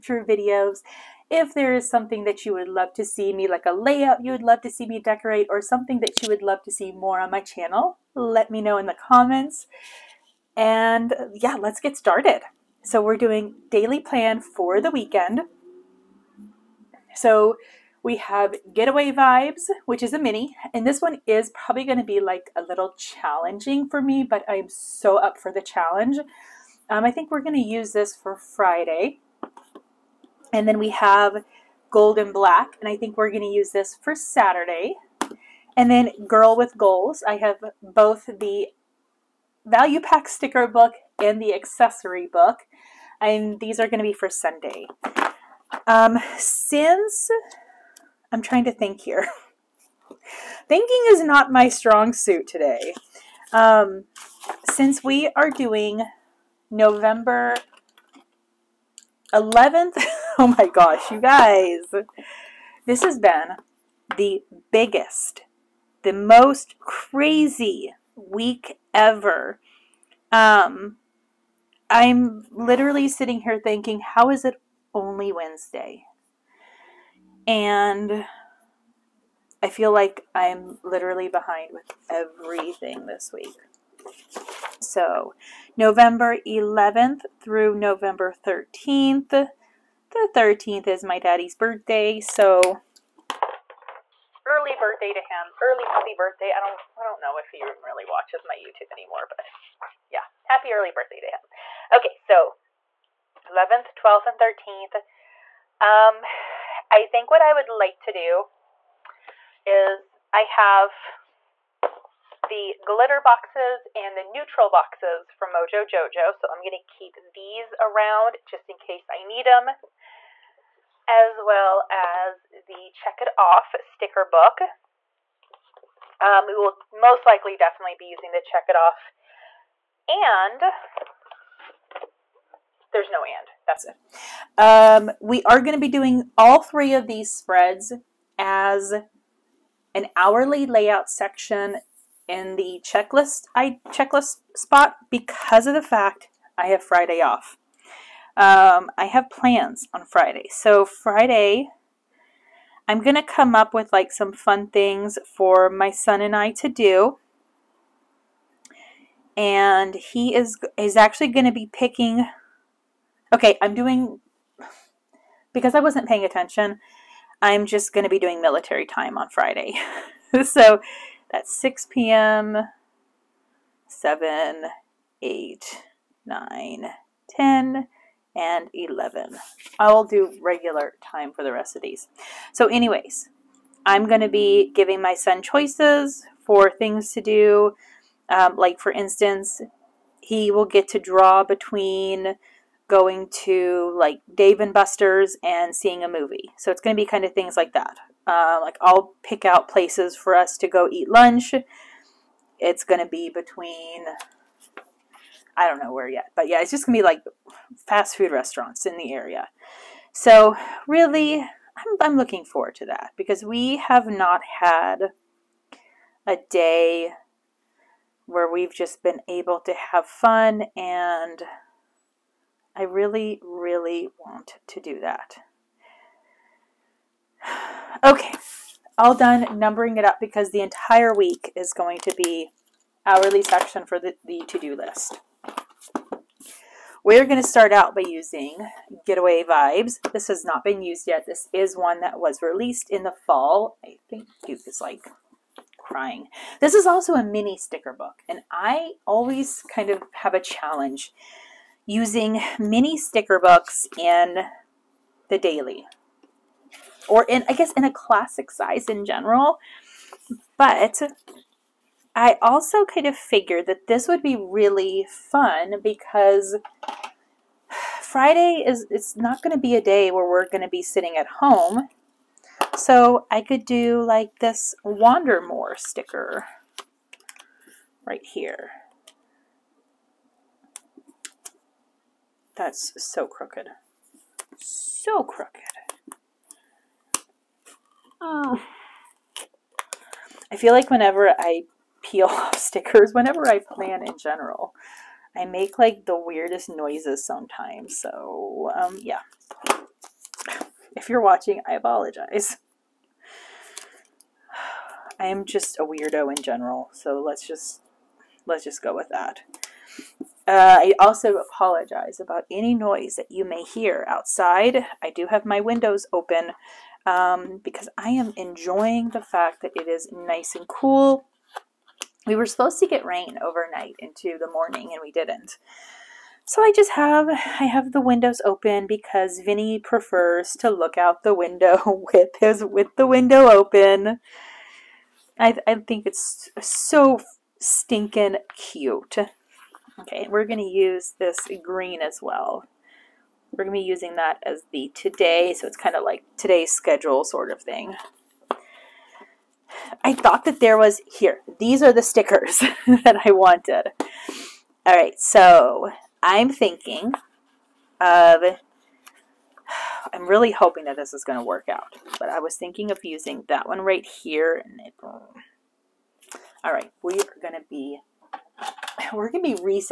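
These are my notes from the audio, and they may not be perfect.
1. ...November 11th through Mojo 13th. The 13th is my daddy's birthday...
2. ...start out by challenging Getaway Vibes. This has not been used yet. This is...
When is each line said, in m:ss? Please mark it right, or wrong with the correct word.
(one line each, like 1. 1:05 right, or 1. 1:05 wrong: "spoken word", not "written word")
1. 1:25 wrong: "November", not "Mojo"
2. 3:57 wrong: "using", not "challenging".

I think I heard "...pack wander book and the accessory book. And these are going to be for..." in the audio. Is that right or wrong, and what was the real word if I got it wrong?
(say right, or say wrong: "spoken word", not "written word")
wrong: "sticker", not "wander".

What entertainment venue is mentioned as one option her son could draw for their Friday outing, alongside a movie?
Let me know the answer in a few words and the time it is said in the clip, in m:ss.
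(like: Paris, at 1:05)
Dave and Buster's, at 3:14.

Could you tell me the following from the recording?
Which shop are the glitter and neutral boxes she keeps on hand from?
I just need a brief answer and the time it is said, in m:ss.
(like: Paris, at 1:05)
Mojo Jojo, at 1:55.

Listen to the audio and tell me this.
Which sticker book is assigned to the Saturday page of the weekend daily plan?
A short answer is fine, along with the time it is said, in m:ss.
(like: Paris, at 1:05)
Gold and Black, at 0:31.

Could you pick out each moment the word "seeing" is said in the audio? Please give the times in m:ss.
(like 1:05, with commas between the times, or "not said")
3:15.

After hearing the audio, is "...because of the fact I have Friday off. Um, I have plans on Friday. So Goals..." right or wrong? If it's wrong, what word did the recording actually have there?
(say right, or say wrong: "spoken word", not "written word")
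wrong: "Friday", not "Goals".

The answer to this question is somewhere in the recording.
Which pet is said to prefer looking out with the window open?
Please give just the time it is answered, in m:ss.
5:29.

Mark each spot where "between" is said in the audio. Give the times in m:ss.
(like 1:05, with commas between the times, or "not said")
3:11, 3:23.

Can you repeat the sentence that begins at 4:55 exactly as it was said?
I make like the weirdest noises sometimes, so um, yeah.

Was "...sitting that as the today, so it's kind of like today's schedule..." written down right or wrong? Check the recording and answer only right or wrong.
wrong.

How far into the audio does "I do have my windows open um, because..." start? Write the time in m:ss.
5:15.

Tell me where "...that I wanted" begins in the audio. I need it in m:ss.
5:52.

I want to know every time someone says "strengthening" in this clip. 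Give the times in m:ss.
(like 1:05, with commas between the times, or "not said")
not said.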